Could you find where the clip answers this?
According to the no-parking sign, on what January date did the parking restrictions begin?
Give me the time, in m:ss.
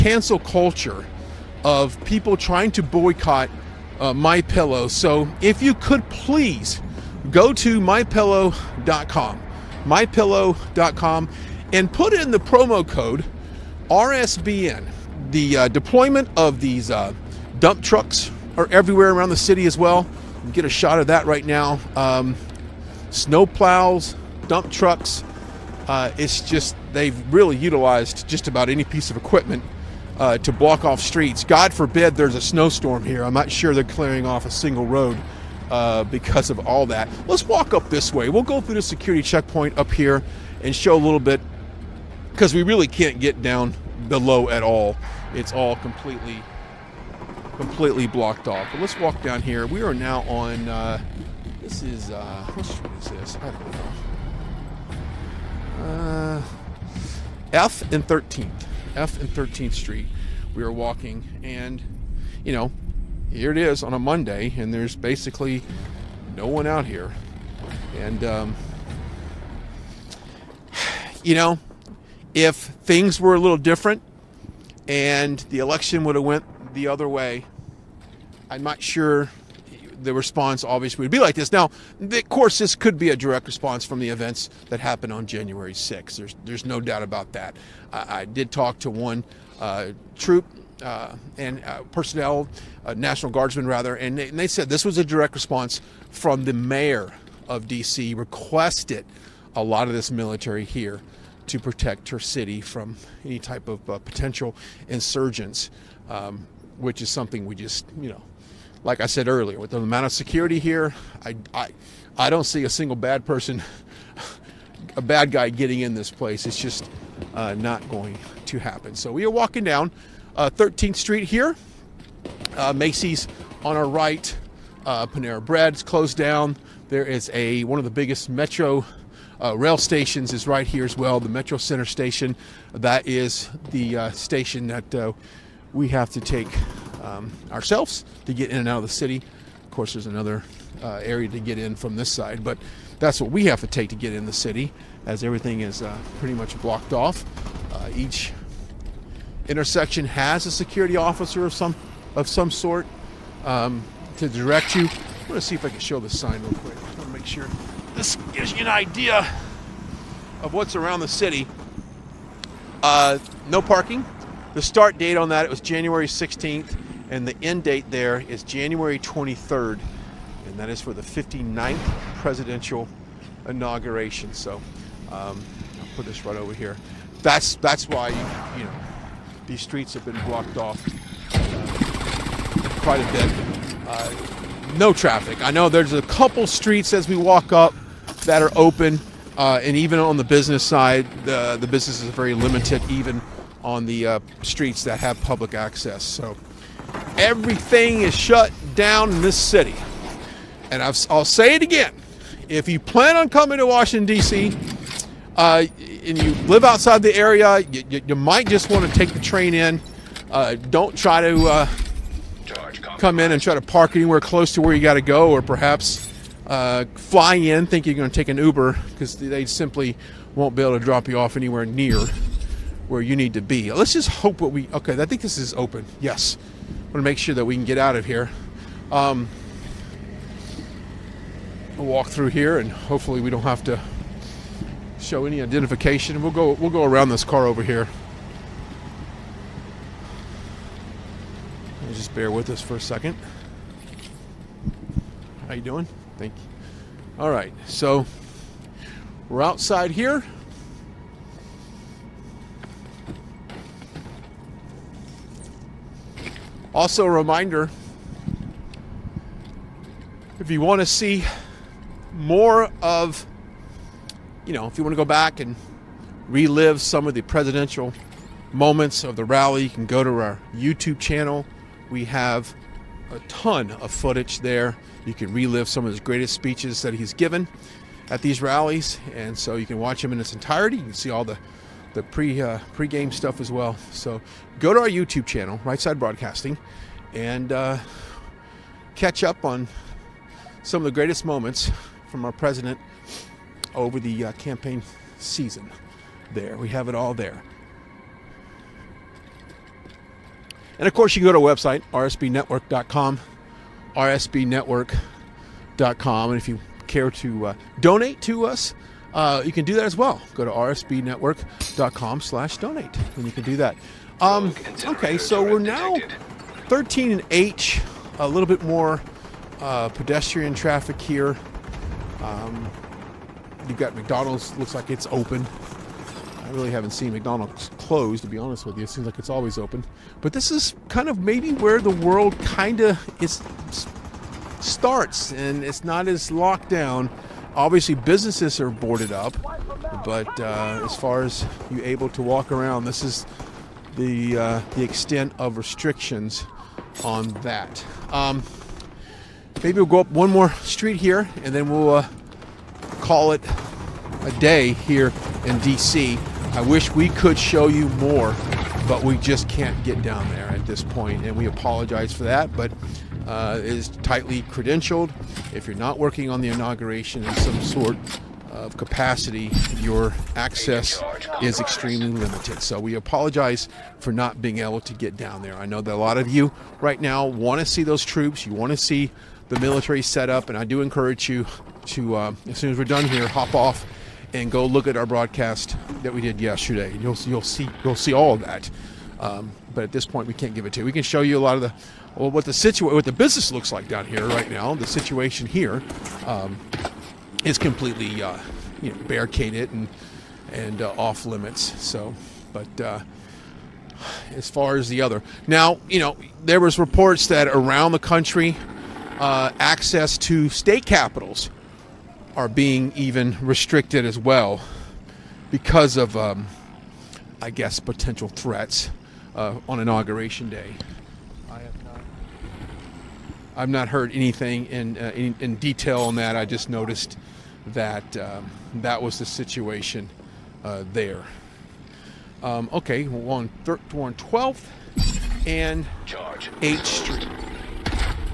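2:45.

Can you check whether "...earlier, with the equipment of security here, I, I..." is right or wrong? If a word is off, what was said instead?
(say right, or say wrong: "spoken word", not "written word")
wrong: "amount", not "equipment".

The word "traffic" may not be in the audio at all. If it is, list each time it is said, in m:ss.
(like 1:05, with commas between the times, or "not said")
3:04, 5:20.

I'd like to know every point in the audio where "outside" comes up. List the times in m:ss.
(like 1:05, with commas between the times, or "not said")
3:26, 4:09.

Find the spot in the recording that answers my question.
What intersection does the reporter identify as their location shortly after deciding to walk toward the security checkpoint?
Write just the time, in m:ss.
0:58.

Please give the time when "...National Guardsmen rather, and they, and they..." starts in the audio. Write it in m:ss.
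1:32.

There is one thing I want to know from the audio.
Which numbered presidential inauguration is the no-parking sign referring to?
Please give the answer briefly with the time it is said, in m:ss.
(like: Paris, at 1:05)
59th, at 2:51.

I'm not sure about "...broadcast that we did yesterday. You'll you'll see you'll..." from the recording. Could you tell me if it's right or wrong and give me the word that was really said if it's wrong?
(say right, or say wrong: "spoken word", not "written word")
right.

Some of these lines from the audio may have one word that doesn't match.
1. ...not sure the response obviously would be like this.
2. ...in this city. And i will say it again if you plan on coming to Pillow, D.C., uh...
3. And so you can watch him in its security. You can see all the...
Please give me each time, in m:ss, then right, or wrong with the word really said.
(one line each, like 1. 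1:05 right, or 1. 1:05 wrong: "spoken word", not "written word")
1. 1:18 right
2. 3:19 wrong: "Washington", not "Pillow"
3. 4:39 wrong: "entirety", not "security".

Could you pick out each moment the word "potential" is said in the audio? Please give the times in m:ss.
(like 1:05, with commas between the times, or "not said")
1:43, 6:57.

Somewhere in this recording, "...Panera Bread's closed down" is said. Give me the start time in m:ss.
2:05.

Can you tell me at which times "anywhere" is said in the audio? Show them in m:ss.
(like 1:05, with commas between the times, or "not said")
3:33, 3:41.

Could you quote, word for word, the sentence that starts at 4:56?
There, we have it all there.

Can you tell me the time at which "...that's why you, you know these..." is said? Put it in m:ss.
2:57.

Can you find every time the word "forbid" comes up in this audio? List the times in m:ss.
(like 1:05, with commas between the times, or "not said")
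0:31.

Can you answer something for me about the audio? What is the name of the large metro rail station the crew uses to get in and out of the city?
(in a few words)
Metro Center.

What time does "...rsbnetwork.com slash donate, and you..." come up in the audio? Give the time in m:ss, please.
5:10.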